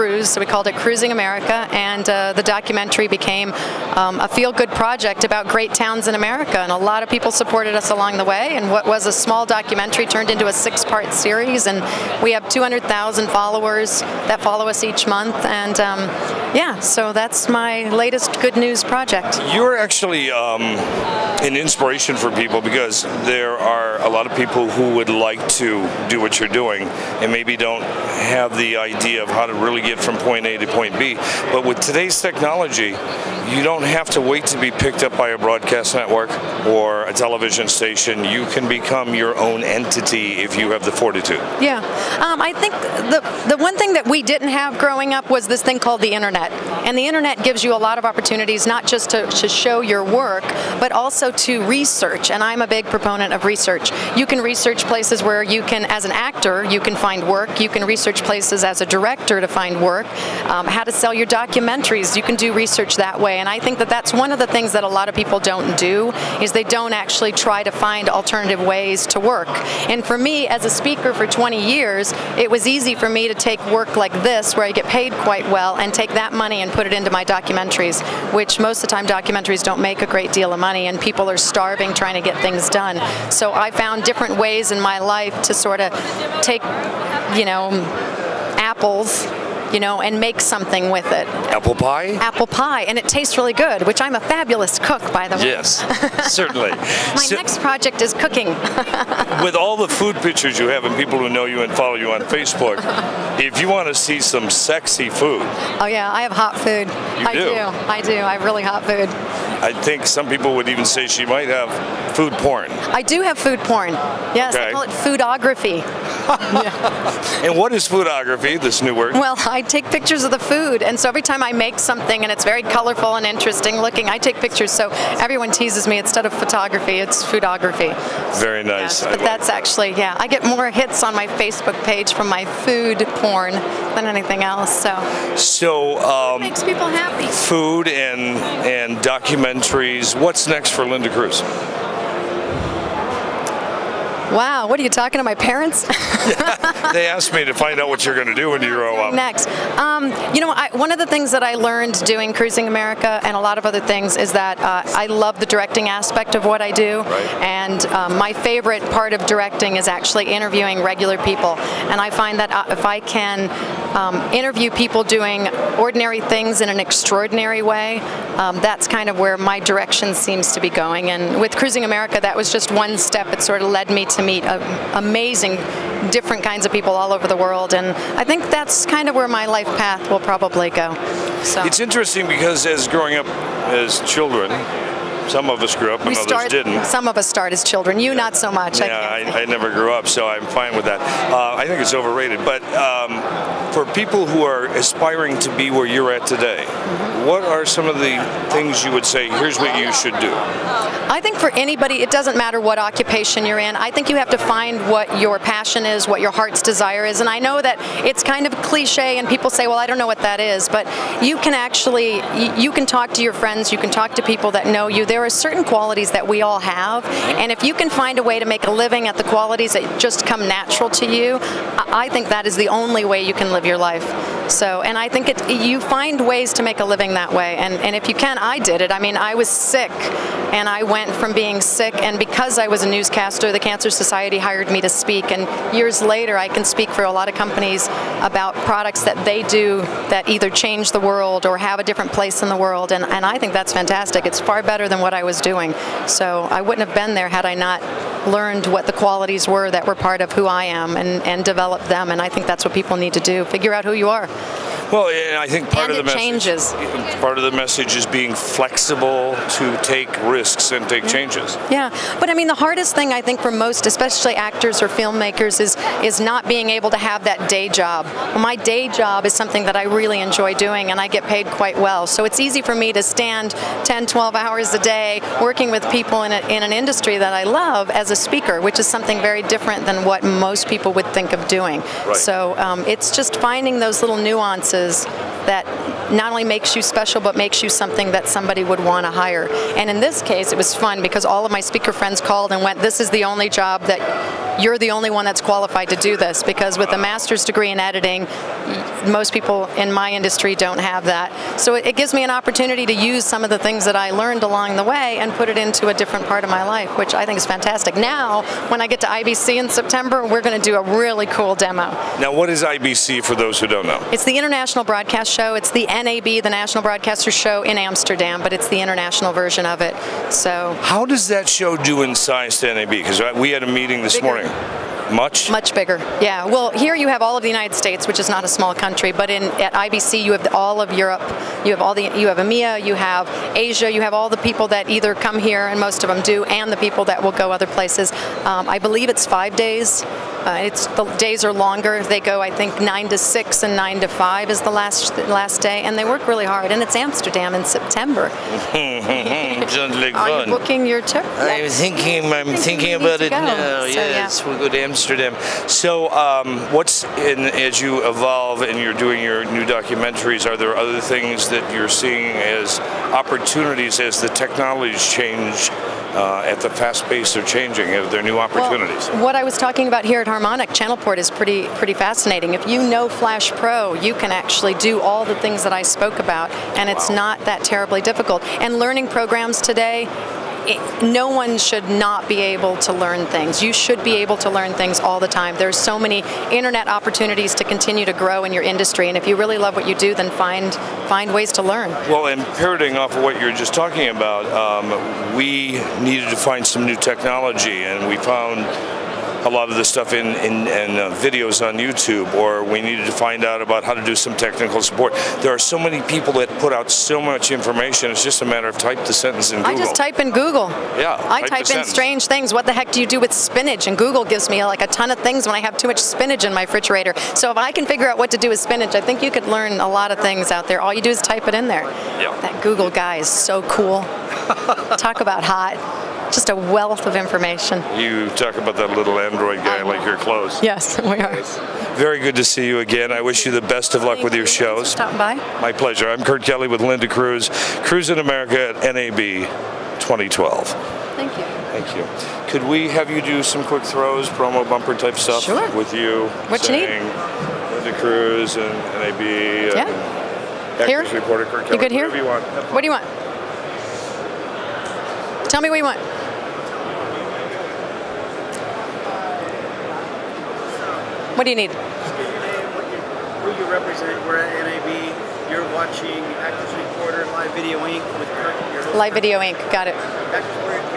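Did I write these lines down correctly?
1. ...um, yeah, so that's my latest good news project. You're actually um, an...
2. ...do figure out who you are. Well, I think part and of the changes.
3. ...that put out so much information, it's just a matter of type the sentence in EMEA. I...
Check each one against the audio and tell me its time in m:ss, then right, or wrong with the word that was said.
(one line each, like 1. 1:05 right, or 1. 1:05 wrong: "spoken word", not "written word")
1. 0:15 right
2. 4:13 right
3. 6:46 wrong: "Google", not "EMEA".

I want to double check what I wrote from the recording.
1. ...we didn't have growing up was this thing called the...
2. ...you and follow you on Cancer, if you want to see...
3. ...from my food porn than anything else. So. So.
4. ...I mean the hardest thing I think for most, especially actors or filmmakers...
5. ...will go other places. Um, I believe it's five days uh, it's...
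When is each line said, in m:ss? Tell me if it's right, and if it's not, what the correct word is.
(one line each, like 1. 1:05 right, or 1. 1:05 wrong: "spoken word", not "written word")
1. 0:44 right
2. 1:41 wrong: "Facebook", not "Cancer"
3. 2:12 right
4. 4:22 right
5. 5:37 right.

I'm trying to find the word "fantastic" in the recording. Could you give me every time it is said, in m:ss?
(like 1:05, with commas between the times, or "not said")
4:03, 5:07.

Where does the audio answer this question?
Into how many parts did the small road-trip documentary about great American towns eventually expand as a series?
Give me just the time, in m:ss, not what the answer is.
0:10.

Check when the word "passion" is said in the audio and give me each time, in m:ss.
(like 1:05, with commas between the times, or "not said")
3:25.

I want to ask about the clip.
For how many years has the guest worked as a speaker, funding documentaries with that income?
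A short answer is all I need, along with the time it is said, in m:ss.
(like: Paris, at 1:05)
20, at 1:11.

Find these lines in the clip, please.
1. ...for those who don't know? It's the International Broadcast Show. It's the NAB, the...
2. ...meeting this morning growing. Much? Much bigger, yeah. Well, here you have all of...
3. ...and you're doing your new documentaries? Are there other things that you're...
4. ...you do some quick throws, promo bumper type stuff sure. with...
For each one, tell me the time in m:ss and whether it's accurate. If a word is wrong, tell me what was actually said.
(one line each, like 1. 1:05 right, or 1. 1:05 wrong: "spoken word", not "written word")
1. 5:13 right
2. 5:23 right
3. 5:58 right
4. 7:23 right.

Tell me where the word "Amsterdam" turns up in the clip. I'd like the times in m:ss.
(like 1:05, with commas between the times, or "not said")
5:17, 5:46, 5:54.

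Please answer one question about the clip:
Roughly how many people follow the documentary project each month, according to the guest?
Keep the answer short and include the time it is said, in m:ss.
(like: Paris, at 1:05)
200,000, at 0:12.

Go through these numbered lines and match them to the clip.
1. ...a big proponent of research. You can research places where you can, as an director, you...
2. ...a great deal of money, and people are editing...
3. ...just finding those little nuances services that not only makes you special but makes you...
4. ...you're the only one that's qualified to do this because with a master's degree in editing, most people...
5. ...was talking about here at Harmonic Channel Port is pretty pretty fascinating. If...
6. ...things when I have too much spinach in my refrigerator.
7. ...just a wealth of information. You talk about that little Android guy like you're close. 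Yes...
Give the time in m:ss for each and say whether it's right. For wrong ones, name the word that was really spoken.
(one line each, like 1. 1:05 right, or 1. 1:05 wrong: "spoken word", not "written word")
1. 0:52 wrong: "actor", not "director"
2. 1:20 wrong: "starving", not "editing"
3. 4:43 right
4. 4:54 right
5. 6:09 right
6. 6:55 right
7. 7:06 right.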